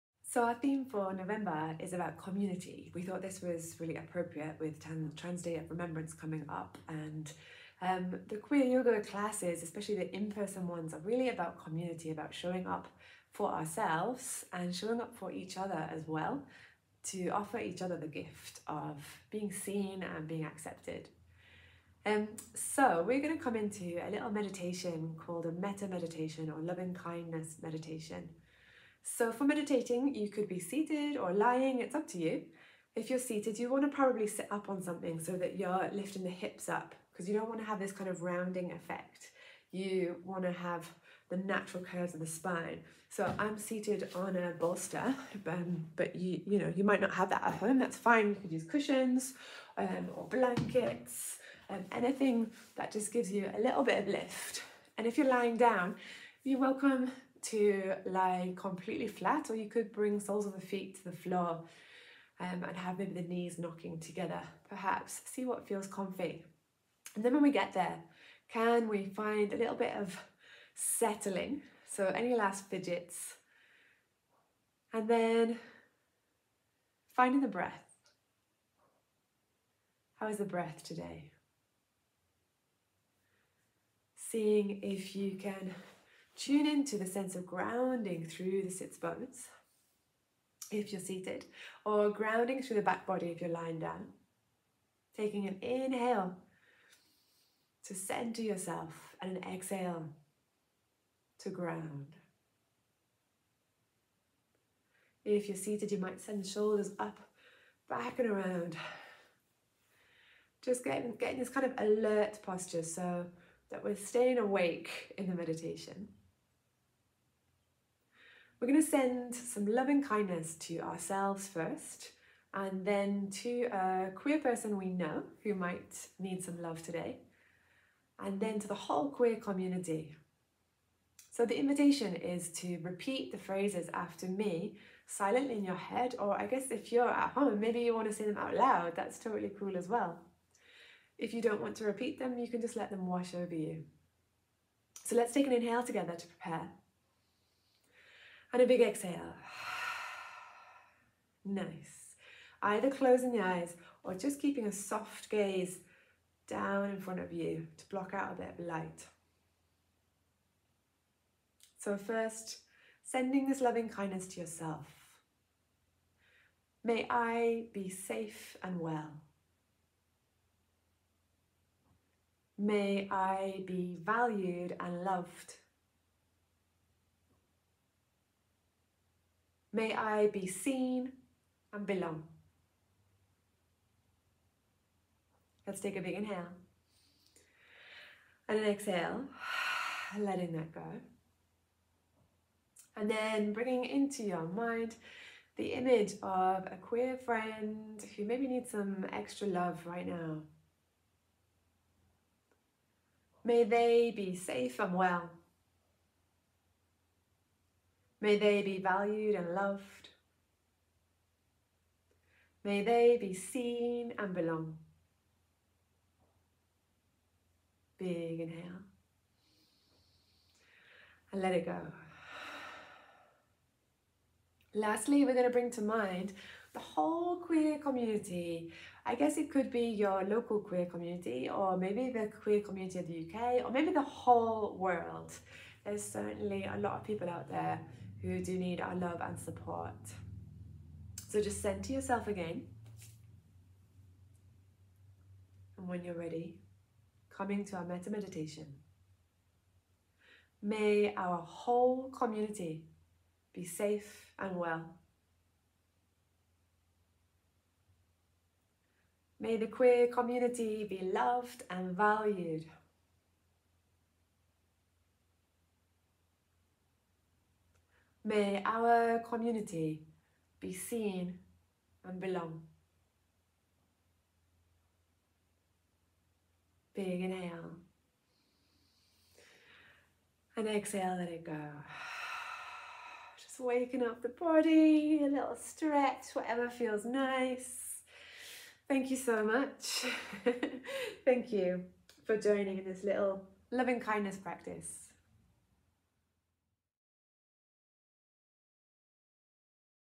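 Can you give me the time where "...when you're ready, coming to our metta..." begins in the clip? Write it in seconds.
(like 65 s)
245 s.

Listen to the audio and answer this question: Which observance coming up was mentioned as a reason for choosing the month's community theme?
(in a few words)
Trans Day of Remembrance.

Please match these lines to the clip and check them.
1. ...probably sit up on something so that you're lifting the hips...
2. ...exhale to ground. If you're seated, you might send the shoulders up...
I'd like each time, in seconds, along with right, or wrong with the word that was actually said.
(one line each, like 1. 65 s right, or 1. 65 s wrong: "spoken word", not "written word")
1. 33 s right
2. 99 s right.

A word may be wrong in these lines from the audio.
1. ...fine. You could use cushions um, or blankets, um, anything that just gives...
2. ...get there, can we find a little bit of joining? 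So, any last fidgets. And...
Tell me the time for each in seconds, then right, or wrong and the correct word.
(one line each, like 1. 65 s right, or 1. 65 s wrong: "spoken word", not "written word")
1. 47 s right
2. 67 s wrong: "settling", not "joining".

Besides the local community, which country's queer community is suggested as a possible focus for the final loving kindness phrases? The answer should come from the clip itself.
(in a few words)
the UK.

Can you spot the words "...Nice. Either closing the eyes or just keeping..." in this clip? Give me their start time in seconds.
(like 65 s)
151 s.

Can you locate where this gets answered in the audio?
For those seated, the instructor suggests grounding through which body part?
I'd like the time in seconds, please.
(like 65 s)
88 s.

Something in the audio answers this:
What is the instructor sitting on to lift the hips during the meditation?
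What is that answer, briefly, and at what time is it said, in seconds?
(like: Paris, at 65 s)
a bolster, at 44 s.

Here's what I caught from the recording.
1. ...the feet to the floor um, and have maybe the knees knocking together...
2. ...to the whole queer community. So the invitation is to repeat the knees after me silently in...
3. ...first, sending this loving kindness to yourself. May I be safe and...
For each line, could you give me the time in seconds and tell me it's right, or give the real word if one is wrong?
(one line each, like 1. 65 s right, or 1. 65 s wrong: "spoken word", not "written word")
1. 60 s right
2. 128 s wrong: "phrases", not "knees"
3. 161 s right.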